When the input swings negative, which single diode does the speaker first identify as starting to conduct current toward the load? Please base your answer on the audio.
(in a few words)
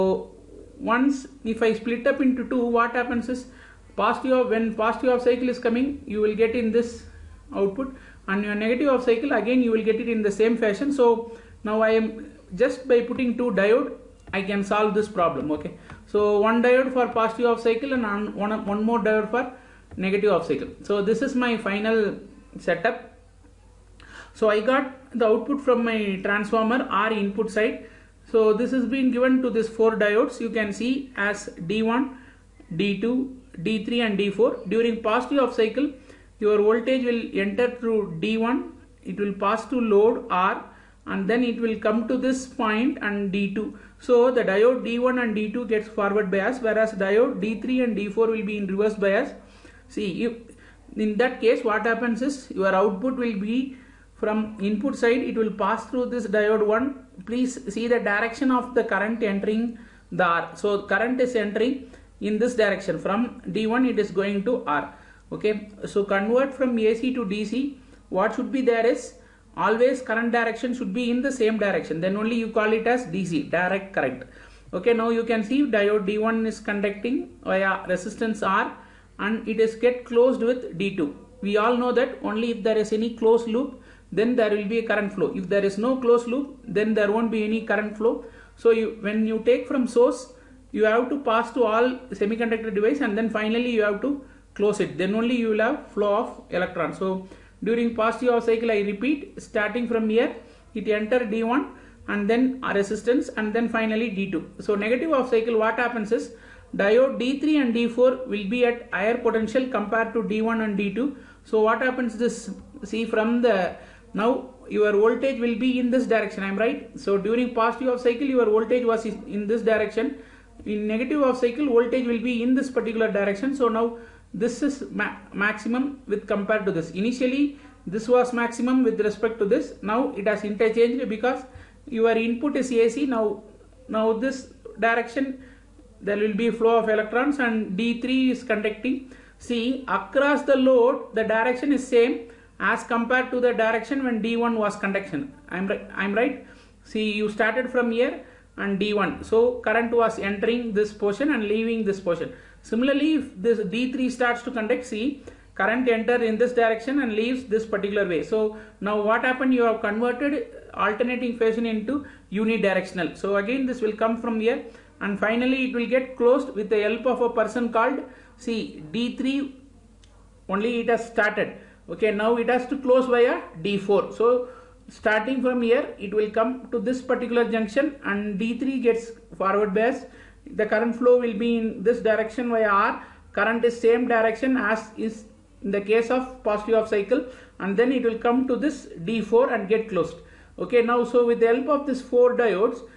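D3.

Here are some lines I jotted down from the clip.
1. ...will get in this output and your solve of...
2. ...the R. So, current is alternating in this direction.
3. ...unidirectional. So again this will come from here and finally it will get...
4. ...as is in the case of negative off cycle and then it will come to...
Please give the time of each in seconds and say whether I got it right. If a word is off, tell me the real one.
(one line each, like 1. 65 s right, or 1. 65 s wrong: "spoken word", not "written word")
1. 6 s wrong: "negative", not "solve"
2. 60 s wrong: "entering", not "alternating"
3. 162 s right
4. 184 s wrong: "positive", not "negative".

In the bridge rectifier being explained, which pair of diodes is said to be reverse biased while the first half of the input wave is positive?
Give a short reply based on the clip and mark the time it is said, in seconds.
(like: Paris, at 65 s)
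D3 and D4, at 46 s.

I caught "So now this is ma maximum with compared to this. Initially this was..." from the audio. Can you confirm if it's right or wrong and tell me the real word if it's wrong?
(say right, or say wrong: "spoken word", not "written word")
right.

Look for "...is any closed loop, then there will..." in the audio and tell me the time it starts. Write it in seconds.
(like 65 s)
82 s.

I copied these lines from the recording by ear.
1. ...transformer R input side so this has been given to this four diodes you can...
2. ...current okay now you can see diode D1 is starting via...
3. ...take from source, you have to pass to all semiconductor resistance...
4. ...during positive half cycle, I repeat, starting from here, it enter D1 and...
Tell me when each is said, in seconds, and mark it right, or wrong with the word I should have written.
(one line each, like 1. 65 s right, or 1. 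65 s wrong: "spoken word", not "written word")
1. 26 s right
2. 73 s wrong: "conducting", not "starting"
3. 89 s wrong: "device", not "resistance"
4. 97 s right.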